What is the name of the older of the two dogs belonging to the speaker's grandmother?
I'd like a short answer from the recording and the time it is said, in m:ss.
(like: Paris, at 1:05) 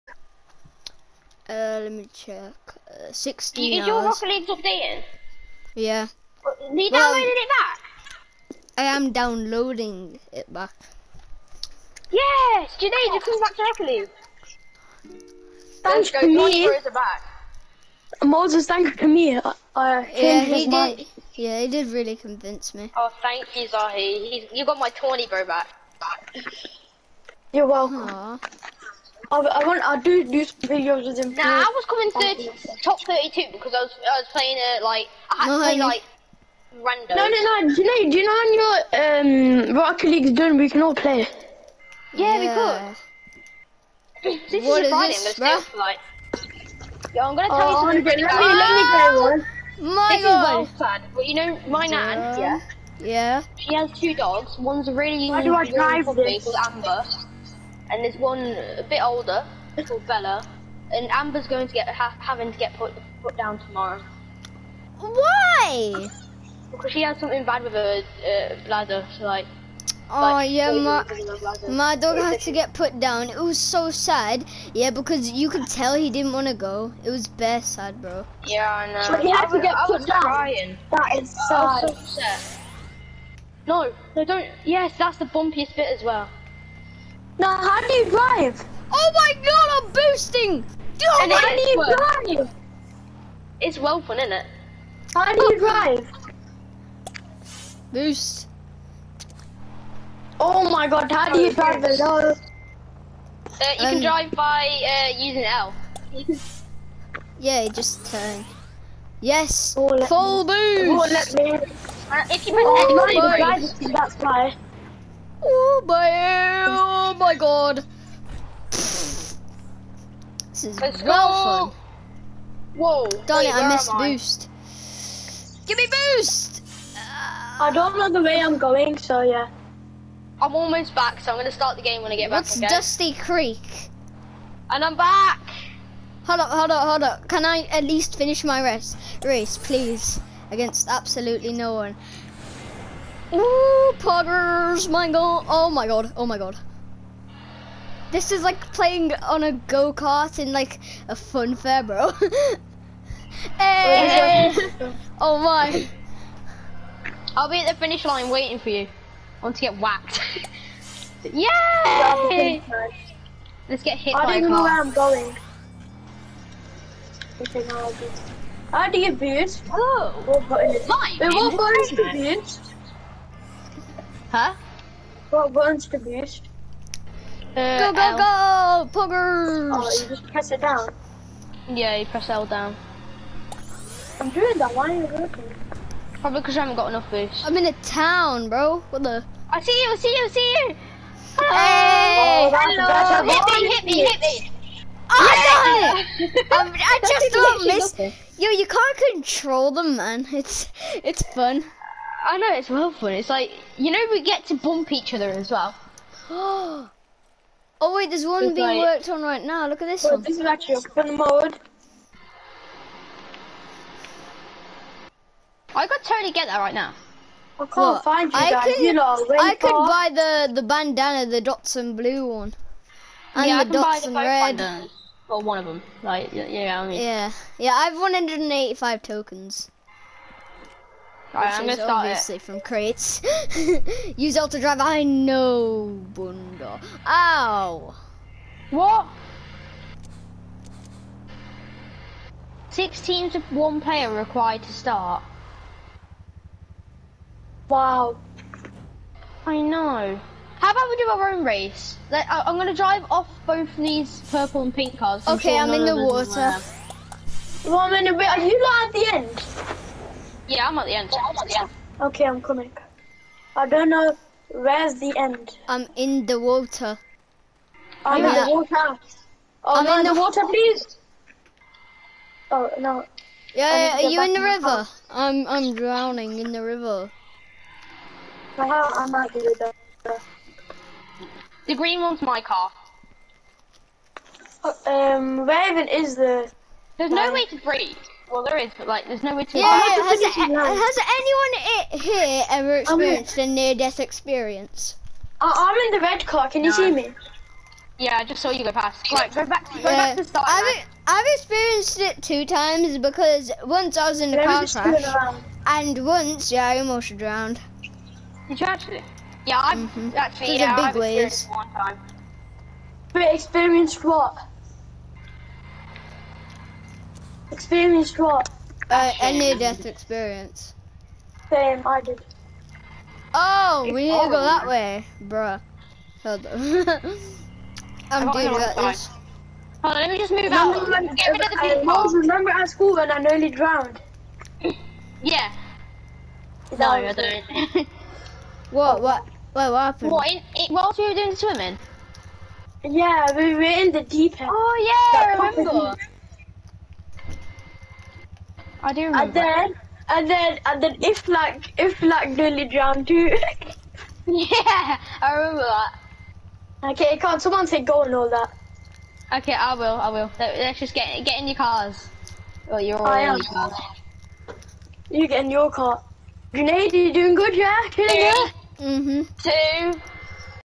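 Bella, at 1:00.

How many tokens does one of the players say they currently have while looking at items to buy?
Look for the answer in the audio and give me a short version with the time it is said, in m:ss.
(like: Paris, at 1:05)
185, at 3:47.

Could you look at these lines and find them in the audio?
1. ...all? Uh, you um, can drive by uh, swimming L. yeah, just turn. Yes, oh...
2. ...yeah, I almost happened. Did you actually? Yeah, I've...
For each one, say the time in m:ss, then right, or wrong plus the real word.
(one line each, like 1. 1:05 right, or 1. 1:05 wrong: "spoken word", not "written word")
1. 1:41 wrong: "using", not "swimming"
2. 5:06 wrong: "drowned", not "happened".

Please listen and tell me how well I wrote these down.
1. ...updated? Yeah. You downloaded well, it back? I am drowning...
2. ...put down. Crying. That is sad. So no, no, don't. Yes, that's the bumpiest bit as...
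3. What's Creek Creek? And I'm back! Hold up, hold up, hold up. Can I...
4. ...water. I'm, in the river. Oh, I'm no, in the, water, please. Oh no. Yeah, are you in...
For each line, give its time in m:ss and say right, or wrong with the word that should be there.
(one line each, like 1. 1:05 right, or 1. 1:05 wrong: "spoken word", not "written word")
1. 0:04 wrong: "downloading", not "drowning"
2. 1:19 right
3. 2:12 wrong: "Dusty", not "Creek"
4. 4:26 wrong: "water", not "river".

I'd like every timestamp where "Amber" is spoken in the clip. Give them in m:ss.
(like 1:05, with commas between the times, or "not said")
0:56, 1:01.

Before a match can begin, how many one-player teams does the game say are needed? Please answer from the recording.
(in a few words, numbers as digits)
Six.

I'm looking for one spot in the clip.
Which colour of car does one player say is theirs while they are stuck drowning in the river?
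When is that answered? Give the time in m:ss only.
4:41.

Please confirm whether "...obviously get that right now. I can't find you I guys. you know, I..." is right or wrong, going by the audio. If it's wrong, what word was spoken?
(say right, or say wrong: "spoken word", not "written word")
wrong: "totally", not "obviously".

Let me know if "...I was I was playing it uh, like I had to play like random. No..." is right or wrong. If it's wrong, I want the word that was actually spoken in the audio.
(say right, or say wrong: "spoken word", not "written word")
right.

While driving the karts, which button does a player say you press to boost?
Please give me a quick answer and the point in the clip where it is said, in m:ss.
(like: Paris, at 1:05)
X, at 1:53.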